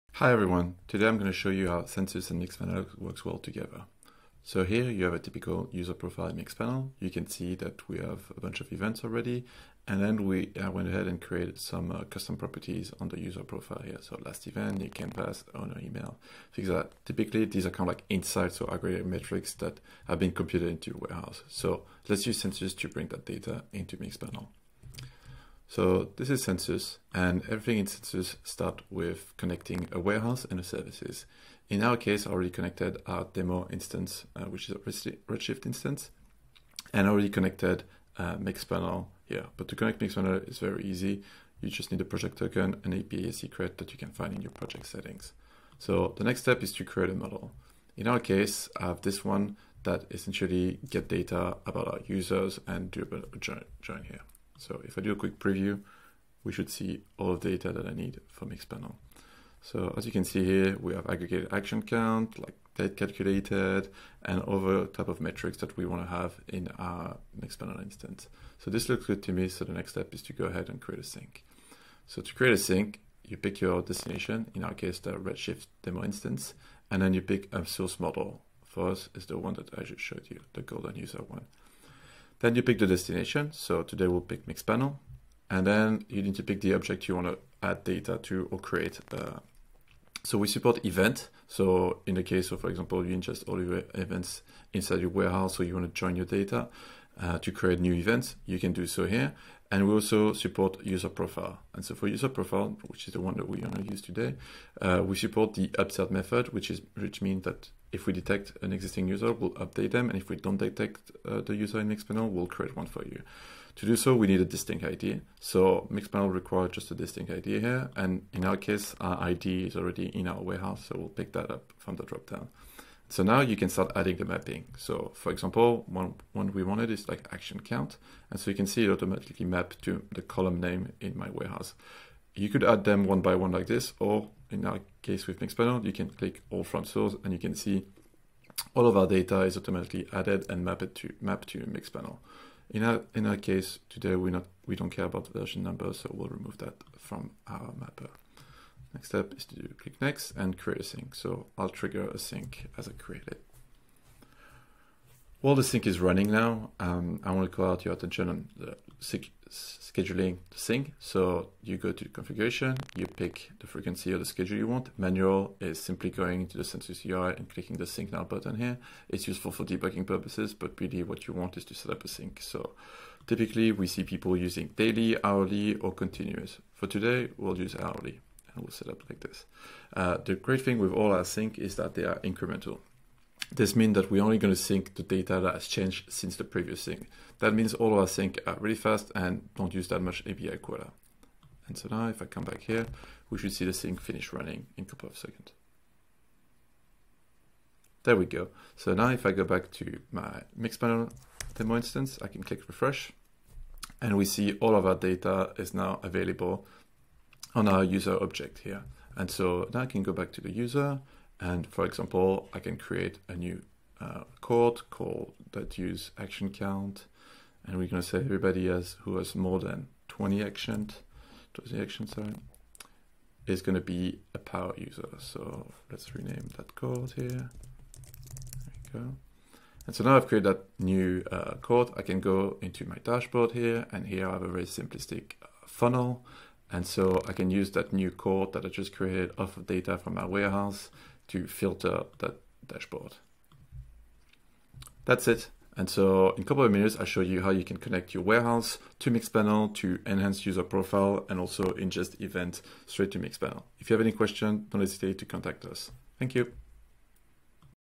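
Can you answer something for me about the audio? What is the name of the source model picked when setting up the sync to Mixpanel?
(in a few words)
golden user.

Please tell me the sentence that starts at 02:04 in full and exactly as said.
So for example, one, one we wanted is like action count.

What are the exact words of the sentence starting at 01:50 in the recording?
And if we don't detect uh, the user in Mixpanel, we'll create one for you.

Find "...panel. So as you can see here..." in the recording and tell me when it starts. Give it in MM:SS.
00:58.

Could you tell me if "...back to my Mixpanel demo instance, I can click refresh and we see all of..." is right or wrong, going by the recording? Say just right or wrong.
right.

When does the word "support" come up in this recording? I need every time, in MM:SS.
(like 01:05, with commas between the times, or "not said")
01:30, 01:40, 01:45.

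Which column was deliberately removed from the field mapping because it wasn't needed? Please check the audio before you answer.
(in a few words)
version number.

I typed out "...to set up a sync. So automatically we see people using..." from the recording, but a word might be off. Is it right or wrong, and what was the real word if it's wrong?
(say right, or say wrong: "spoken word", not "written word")
wrong: "typically", not "automatically".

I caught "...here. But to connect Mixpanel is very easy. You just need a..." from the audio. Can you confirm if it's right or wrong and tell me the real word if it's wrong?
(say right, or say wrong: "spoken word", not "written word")
right.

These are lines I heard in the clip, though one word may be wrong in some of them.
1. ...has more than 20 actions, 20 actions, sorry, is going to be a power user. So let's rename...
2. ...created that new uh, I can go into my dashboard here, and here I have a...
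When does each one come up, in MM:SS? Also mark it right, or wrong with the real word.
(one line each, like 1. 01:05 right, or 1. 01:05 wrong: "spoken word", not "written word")
1. 03:39 right
2. 03:50 right.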